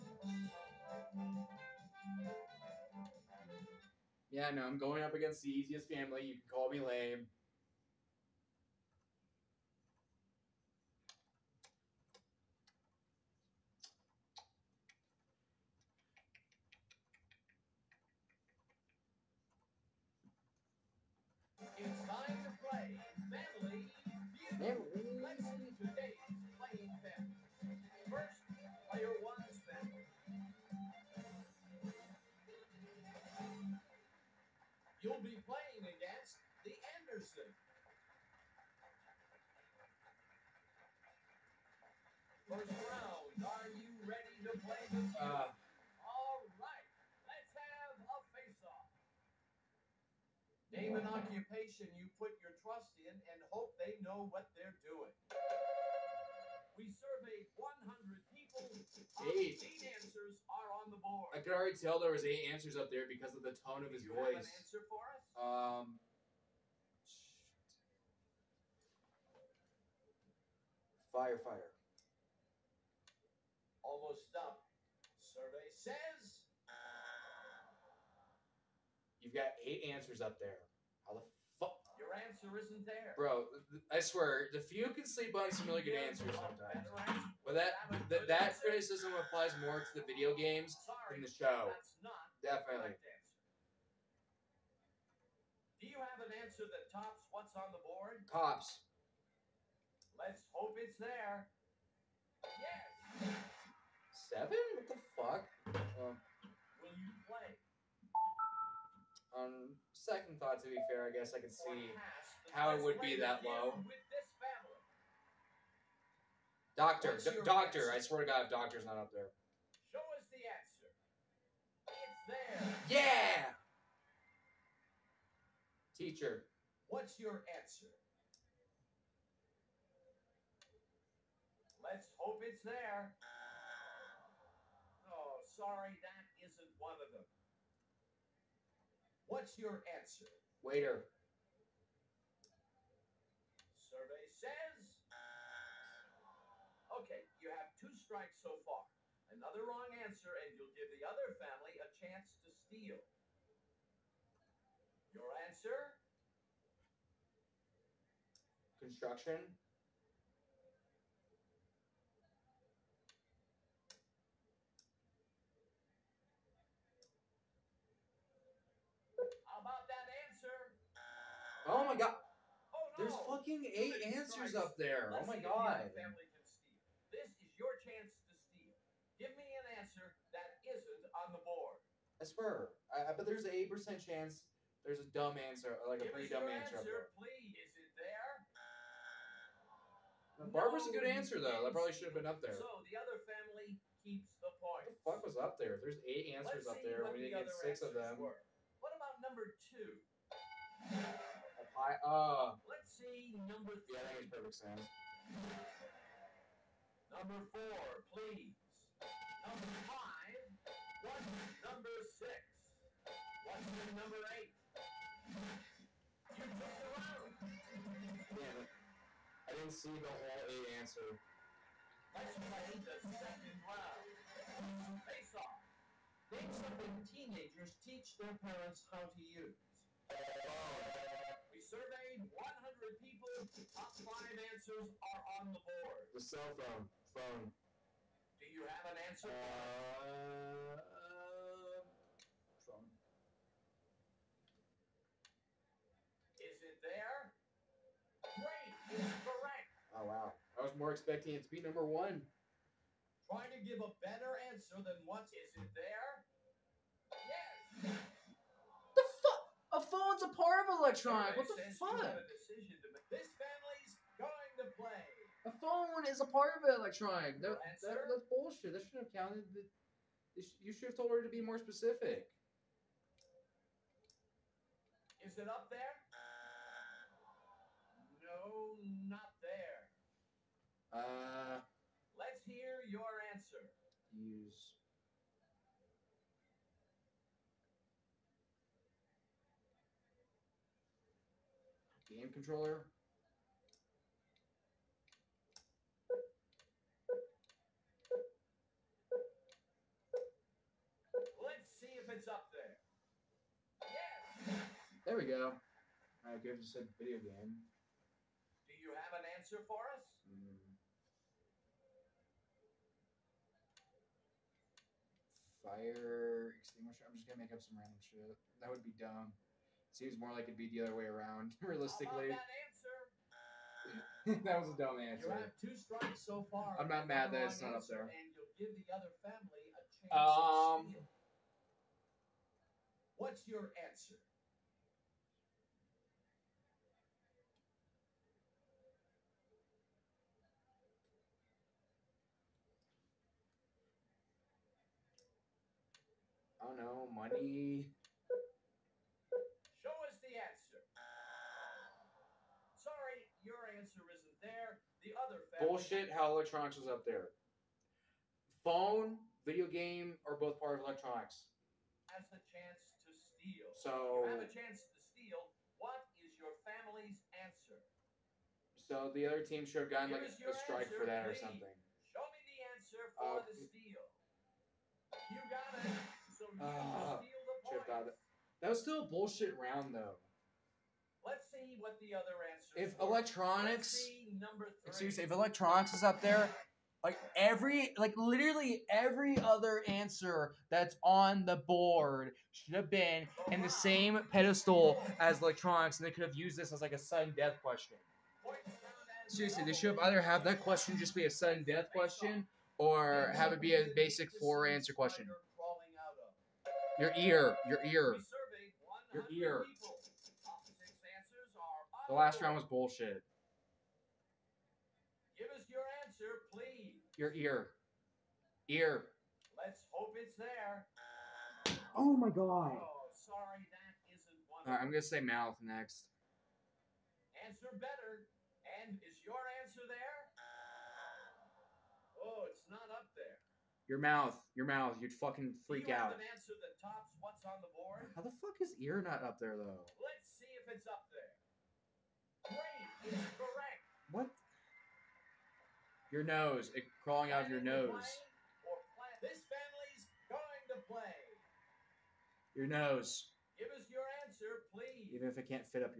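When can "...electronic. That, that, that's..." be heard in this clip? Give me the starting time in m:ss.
4:26.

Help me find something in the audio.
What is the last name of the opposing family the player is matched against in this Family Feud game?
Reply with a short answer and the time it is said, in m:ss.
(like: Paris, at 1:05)
Anderson, at 0:36.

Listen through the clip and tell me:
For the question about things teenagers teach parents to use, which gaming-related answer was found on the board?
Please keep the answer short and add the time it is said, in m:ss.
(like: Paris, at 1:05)
Game controller, at 4:52.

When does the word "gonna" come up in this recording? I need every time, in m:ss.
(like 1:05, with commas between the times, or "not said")
5:17, 7:04.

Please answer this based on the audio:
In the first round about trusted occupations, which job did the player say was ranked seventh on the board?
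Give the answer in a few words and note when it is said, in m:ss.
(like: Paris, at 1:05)
Cops, at 1:38.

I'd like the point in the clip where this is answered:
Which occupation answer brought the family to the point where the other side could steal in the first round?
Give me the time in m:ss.
2:38.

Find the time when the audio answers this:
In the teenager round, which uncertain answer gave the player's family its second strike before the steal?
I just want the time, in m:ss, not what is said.
5:47.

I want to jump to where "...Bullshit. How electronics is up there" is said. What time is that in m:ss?
5:55.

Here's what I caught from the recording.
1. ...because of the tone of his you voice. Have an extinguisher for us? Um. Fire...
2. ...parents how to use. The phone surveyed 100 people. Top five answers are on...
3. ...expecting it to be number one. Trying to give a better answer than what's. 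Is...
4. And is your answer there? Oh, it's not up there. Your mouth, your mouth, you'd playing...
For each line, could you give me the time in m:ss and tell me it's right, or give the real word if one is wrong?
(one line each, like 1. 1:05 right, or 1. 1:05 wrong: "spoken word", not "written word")
1. 1:03 wrong: "answer", not "extinguisher"
2. 3:48 right
3. 4:10 right
4. 7:08 wrong: "fucking", not "playing".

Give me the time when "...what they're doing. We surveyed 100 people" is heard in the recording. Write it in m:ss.
0:54.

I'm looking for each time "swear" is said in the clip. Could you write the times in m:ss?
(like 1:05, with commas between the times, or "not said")
1:23, 1:57, 3:02.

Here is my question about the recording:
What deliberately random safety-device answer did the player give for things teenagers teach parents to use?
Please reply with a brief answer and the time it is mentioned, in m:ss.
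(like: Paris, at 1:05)
Fire extinguisher, at 5:15.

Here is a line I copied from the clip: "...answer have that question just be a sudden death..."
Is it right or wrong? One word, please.
wrong.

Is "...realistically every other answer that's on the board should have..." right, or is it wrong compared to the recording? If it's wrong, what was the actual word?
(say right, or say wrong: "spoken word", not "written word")
wrong: "literally", not "realistically".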